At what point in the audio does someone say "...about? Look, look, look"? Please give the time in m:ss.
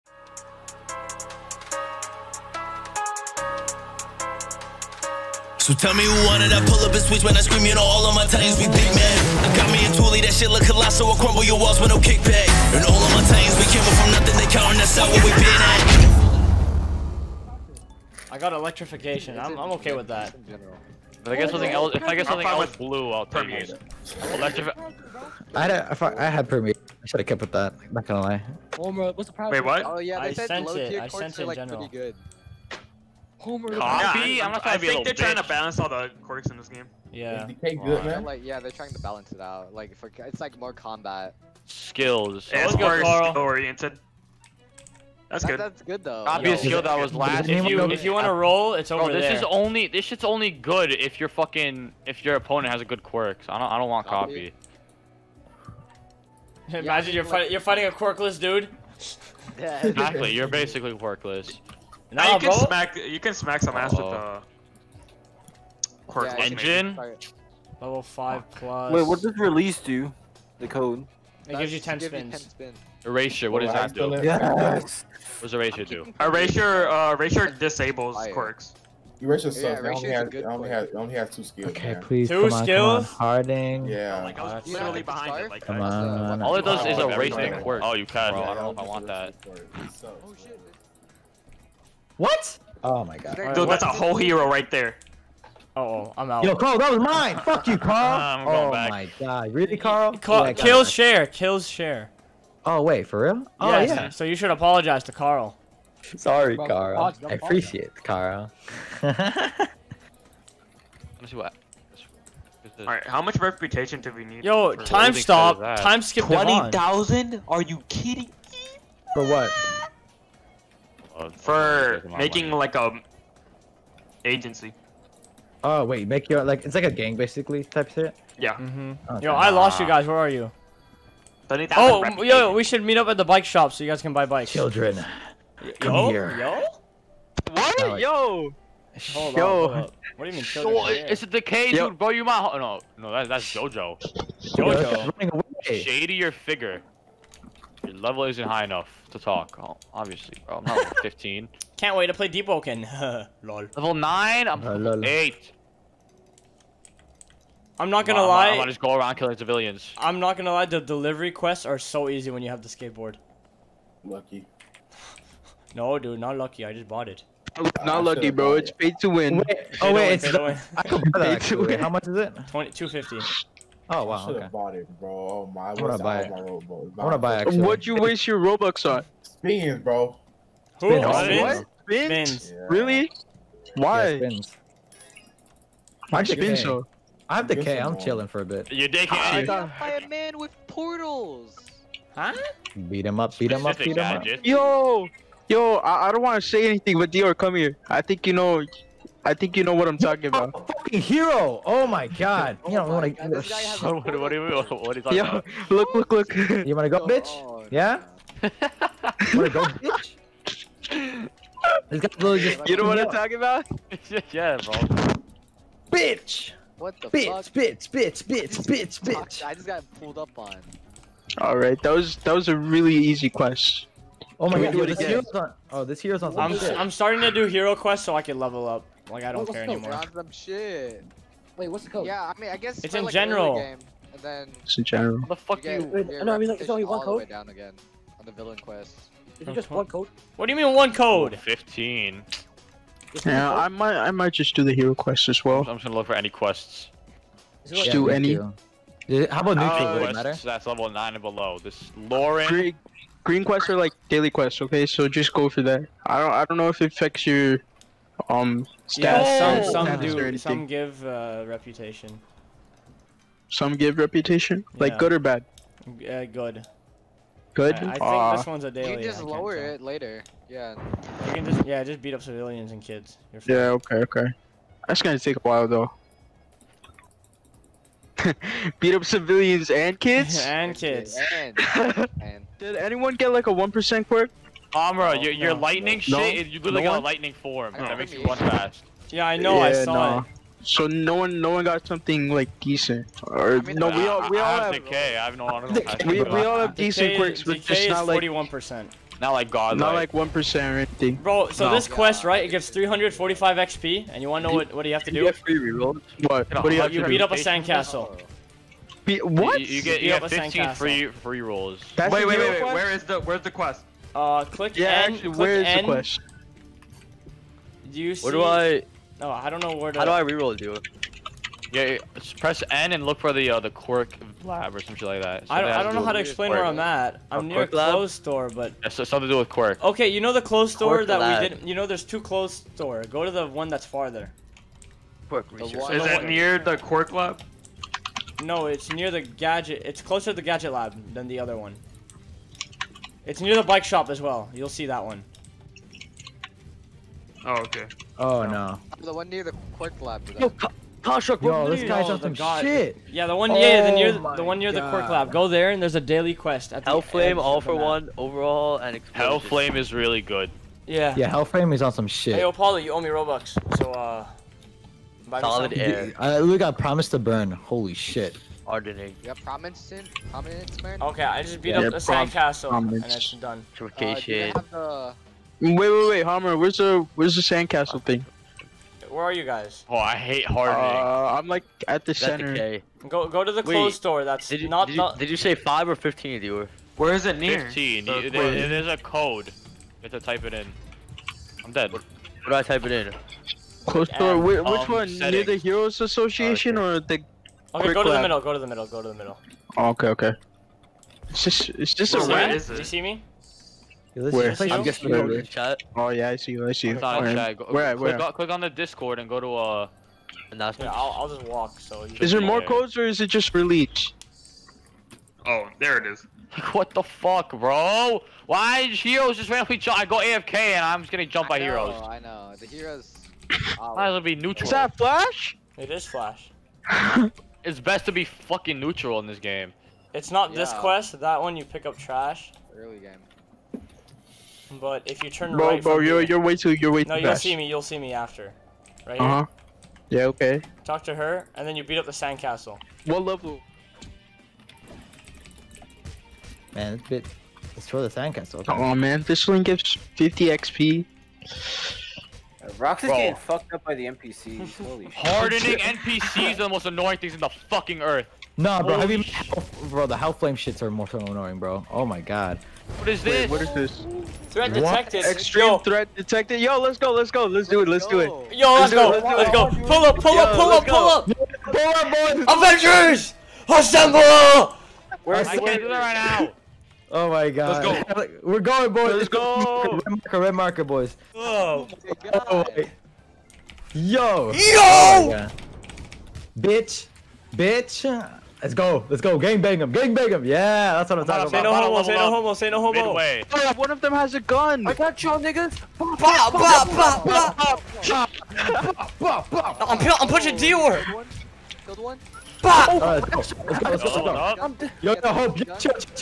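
3:25.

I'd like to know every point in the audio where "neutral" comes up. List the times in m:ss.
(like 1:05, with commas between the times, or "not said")
4:09, 7:04, 7:08.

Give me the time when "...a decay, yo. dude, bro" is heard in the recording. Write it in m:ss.
2:21.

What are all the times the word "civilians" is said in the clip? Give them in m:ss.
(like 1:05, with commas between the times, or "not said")
2:39, 4:32, 4:39.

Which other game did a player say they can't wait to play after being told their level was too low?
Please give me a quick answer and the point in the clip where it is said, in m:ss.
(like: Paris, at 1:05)
Deepwoken, at 2:32.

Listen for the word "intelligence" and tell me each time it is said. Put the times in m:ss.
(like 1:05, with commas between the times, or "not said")
not said.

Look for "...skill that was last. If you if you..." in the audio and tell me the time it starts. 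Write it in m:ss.
0:46.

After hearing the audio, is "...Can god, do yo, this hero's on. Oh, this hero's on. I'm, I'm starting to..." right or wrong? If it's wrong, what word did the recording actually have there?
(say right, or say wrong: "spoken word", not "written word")
right.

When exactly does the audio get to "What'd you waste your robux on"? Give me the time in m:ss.
2:57.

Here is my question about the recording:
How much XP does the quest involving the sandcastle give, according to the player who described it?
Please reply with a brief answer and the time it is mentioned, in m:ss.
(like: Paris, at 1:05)
345, at 5:02.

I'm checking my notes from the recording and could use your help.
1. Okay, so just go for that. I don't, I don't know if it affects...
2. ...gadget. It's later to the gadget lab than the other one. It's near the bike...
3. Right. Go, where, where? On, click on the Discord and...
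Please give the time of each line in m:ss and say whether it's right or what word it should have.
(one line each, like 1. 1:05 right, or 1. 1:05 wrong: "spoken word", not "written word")
1. 4:14 right
2. 5:39 wrong: "closer", not "later"
3. 6:46 right.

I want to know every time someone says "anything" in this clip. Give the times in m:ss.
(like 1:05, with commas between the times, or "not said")
3:16, 5:00.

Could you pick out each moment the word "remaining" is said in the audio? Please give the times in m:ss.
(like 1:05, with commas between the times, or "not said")
not said.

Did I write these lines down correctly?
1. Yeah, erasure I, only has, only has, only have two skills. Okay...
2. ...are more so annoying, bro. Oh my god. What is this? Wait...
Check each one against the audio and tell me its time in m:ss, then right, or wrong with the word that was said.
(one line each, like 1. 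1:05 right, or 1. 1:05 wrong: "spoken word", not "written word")
1. 1:19 right
2. 7:40 right.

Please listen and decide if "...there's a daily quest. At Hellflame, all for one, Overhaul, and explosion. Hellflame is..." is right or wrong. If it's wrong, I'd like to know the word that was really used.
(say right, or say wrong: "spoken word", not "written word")
right.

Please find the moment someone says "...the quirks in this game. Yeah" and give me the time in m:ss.
0:35.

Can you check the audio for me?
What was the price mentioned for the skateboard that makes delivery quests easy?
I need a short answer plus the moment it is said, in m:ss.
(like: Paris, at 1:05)
250, at 2:52.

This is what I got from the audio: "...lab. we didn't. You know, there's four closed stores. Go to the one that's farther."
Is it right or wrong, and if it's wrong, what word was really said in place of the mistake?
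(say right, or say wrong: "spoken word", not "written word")
wrong: "two", not "four".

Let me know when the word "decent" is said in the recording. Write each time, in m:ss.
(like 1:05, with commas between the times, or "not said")
4:52, 4:56.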